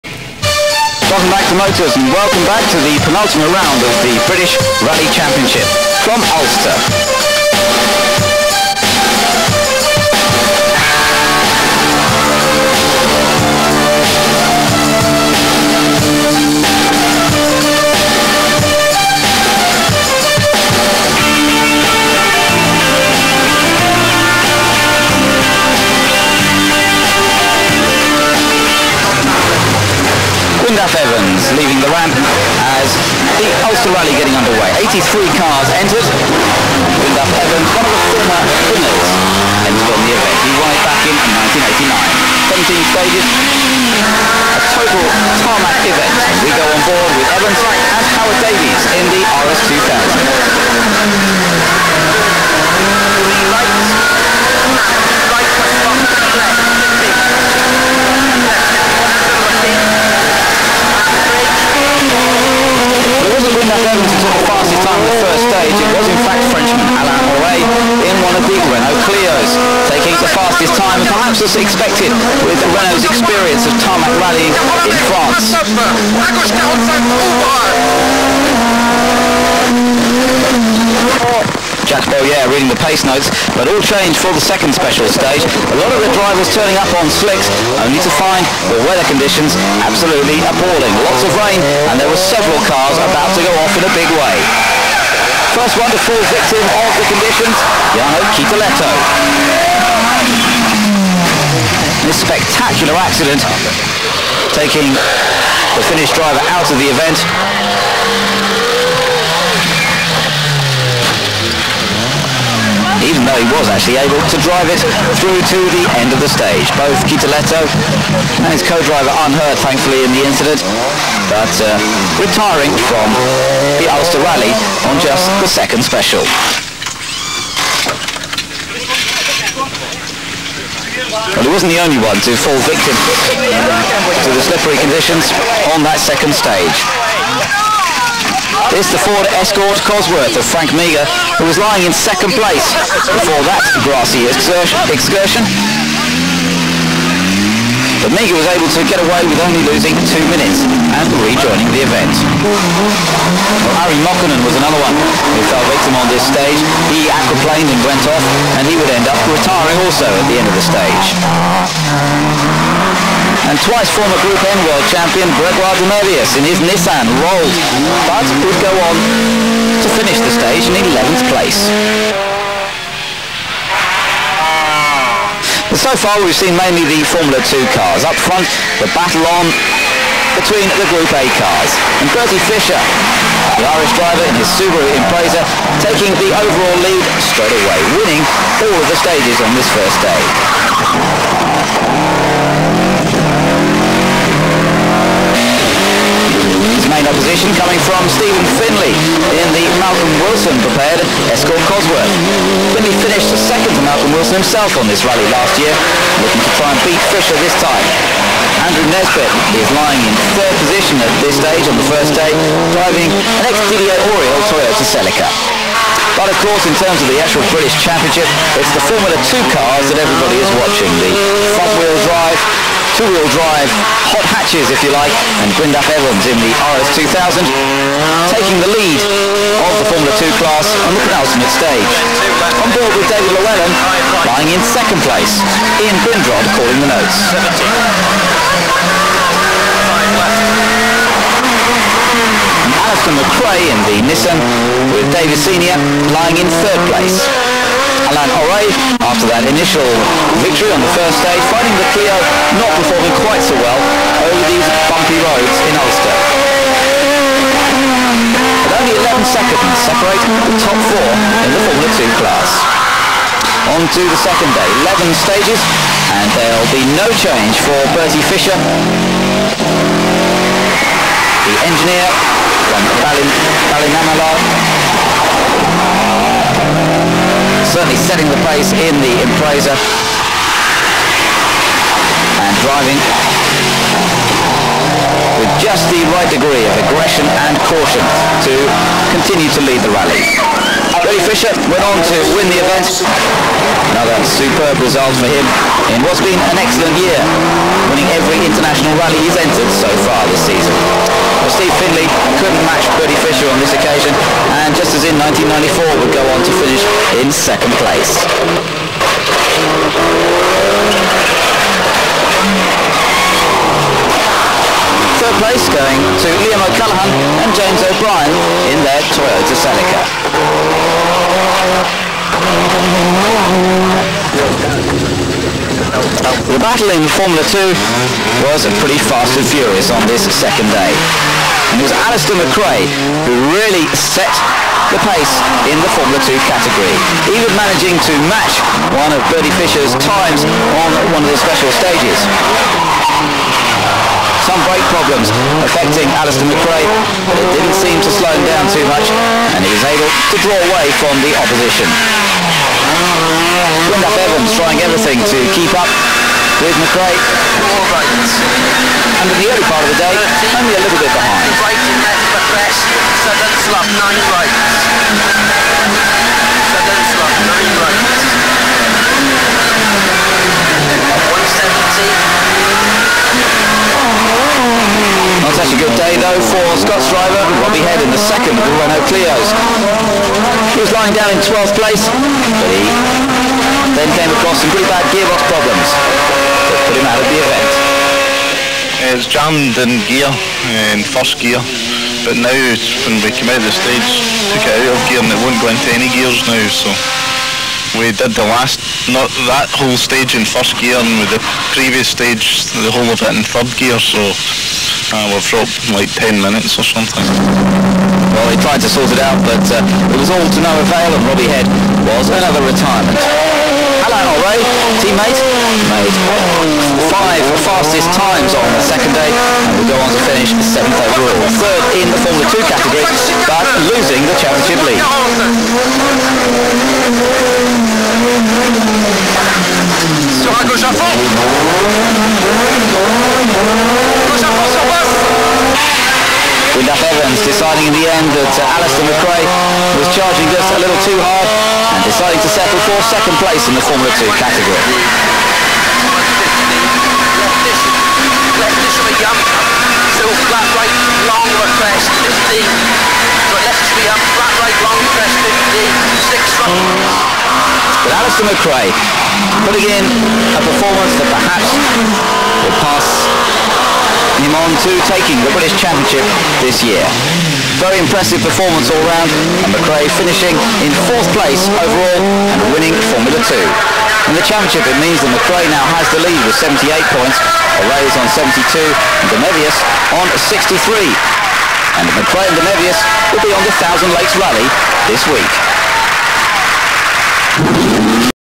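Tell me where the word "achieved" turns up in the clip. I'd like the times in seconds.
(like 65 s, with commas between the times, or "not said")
not said.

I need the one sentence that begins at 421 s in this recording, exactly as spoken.
Third in the Formula 2 category, but losing the championship lead.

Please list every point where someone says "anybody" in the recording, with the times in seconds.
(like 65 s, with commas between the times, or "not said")
not said.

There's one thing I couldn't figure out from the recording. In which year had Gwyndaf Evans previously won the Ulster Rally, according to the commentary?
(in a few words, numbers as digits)
1989.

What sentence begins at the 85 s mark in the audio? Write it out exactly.
A lot of the drivers turning up on slicks, only to find the weather conditions absolutely appalling.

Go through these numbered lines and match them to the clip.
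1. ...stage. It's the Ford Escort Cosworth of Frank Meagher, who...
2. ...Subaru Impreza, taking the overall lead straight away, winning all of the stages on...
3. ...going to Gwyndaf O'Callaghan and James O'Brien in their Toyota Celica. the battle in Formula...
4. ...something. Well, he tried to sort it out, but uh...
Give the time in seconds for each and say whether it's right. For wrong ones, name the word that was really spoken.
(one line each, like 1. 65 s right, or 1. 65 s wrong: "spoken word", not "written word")
1. 136 s right
2. 184 s right
3. 315 s wrong: "Liam", not "Gwyndaf"
4. 406 s right.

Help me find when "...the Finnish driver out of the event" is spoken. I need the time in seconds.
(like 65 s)
105 s.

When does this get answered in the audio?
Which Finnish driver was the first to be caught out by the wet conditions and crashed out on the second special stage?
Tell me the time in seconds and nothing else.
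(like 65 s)
97 s.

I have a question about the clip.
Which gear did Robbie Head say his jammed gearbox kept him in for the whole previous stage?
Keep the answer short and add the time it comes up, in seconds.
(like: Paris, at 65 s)
third gear, at 403 s.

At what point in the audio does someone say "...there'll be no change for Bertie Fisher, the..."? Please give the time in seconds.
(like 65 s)
266 s.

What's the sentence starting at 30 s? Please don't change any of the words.
Gwyndaf Evans leaving the ramp as the Ulster Rally getting underway.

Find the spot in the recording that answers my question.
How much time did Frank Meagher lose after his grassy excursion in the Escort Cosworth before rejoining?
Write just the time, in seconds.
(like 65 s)
150 s.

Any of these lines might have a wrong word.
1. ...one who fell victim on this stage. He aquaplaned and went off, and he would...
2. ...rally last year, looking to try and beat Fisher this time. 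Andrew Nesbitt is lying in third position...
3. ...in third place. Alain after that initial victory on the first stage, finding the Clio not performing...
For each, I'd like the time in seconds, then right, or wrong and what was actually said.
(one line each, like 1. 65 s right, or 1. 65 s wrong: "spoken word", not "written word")
1. 154 s right
2. 205 s right
3. 246 s right.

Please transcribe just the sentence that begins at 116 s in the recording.
Both Kytölehto and his co-driver unhurt, thankfully, in the incident, but uh, retiring from the Ulster Rally on just the second special.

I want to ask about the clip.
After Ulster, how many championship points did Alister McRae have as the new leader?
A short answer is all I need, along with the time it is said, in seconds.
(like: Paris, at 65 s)
78, at 476 s.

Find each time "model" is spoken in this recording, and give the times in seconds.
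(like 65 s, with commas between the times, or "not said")
not said.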